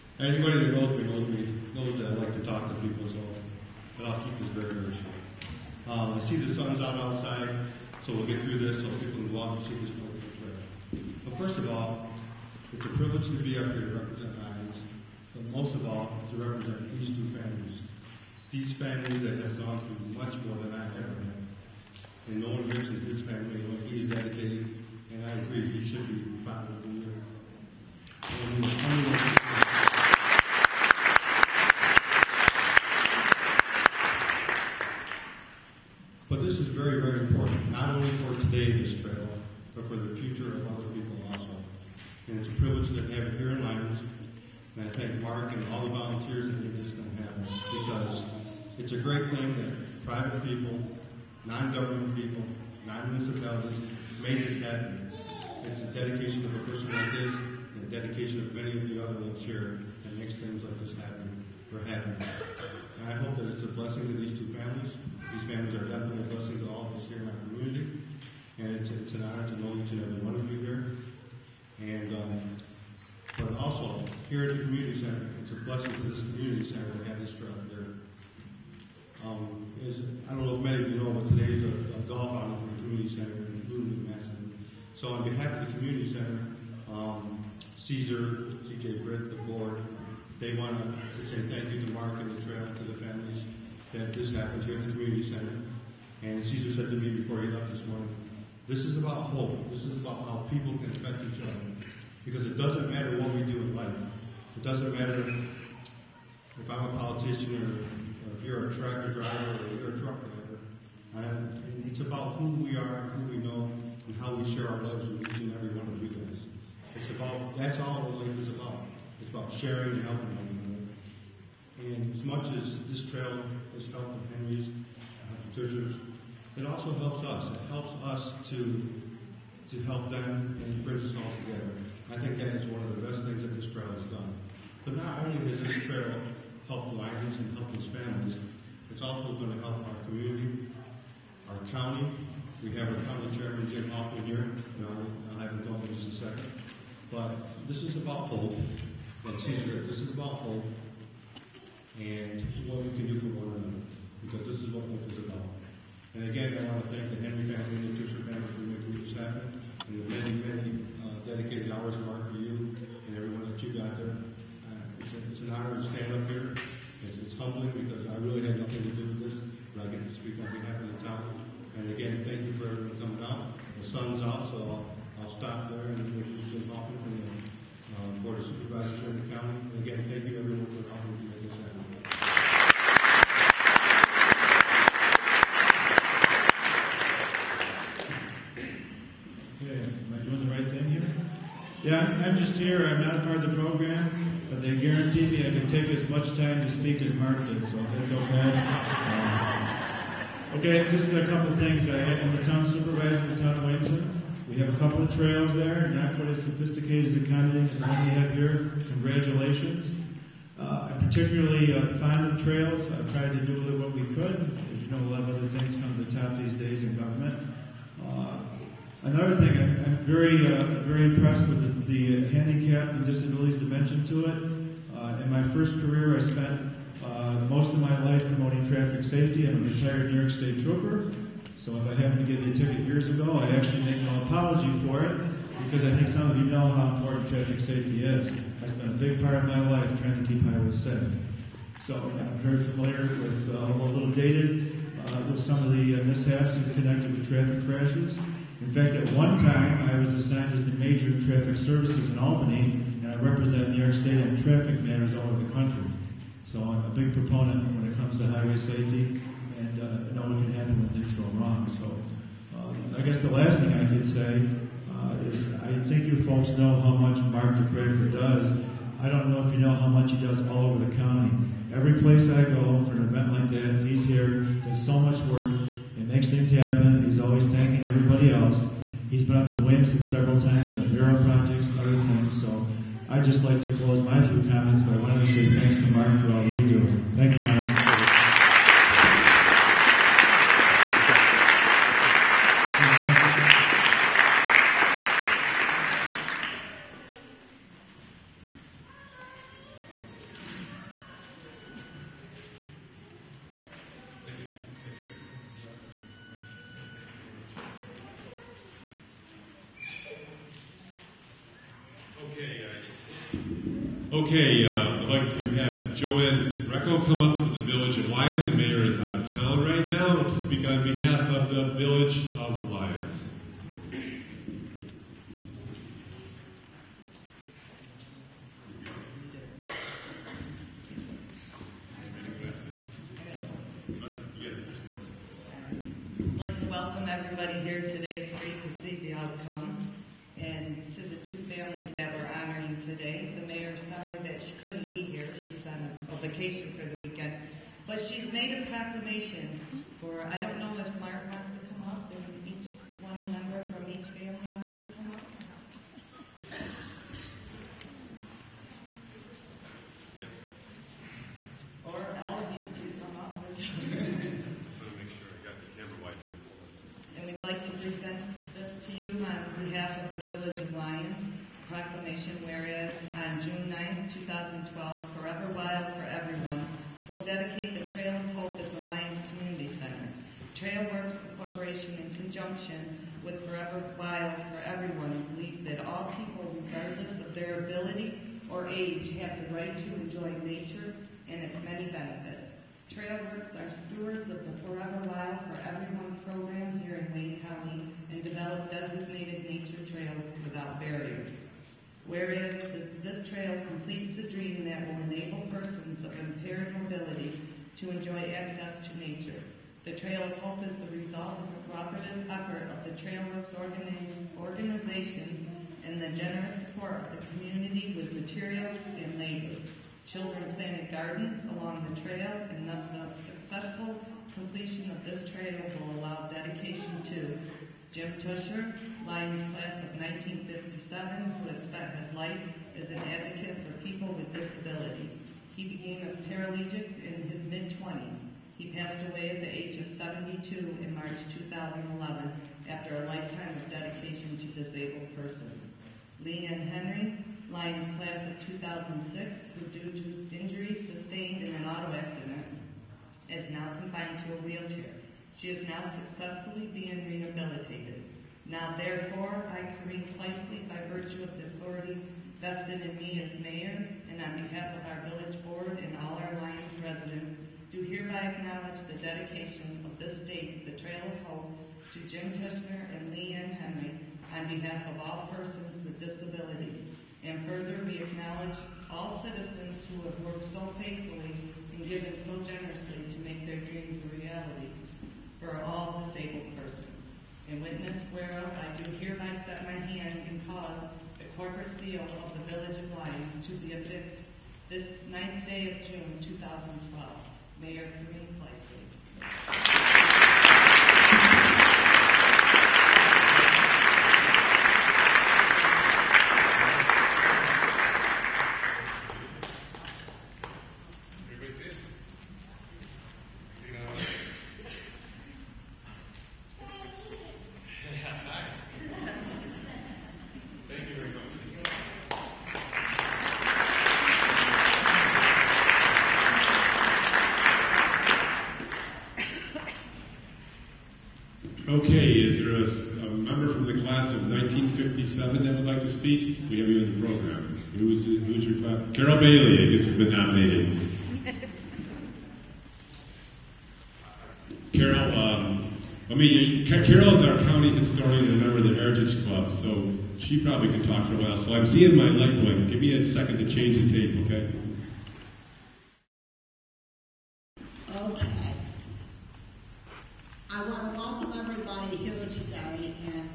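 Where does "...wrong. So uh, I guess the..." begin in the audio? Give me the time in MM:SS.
04:21.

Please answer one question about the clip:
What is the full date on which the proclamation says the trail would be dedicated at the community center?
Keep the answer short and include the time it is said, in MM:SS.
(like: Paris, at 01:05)
June 9, 2012, at 06:13.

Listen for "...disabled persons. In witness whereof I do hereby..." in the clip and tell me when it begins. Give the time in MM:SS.
08:06.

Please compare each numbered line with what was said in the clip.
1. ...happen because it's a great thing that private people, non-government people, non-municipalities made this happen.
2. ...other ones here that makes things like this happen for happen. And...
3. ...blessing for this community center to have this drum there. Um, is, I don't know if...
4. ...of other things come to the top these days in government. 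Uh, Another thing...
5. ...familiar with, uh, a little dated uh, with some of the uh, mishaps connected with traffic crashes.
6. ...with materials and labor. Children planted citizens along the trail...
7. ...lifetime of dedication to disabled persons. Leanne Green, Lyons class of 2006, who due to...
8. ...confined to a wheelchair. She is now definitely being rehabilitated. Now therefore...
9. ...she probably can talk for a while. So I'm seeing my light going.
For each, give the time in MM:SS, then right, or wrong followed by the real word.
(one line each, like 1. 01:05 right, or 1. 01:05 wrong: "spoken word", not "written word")
1. 00:47 right
2. 00:59 right
3. 01:15 right
4. 03:35 right
5. 04:02 right
6. 06:57 wrong: "gardens", not "citizens"
7. 07:23 wrong: "Henry", not "Green"
8. 07:33 wrong: "successfully", not "definitely"
9. 09:10 right.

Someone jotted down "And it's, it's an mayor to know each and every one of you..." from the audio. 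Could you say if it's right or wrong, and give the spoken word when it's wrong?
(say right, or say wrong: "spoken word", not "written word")
wrong: "honor", not "mayor".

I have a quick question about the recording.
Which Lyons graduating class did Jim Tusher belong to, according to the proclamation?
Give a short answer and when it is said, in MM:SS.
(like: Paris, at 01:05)
1957, at 07:09.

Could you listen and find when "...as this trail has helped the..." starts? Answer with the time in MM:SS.
02:02.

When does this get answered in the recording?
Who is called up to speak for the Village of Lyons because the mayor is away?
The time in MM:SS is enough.
05:15.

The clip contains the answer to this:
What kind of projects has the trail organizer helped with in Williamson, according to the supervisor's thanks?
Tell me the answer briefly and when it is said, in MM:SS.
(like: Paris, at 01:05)
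Mural projects, at 04:40.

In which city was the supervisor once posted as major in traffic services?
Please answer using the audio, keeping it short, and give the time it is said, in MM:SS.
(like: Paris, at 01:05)
Albany, at 04:12.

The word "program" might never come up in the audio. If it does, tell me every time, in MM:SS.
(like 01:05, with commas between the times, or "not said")
03:13, 06:36, 08:57.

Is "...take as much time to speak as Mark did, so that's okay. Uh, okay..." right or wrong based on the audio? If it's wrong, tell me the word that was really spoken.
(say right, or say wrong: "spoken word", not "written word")
right.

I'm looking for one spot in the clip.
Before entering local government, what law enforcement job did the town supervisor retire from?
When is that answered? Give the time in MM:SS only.
03:50.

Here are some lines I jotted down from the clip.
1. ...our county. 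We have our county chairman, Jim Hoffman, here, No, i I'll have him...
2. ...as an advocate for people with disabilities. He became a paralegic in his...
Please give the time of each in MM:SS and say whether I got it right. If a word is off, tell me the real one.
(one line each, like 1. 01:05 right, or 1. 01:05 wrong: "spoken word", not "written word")
1. 02:21 right
2. 07:12 right.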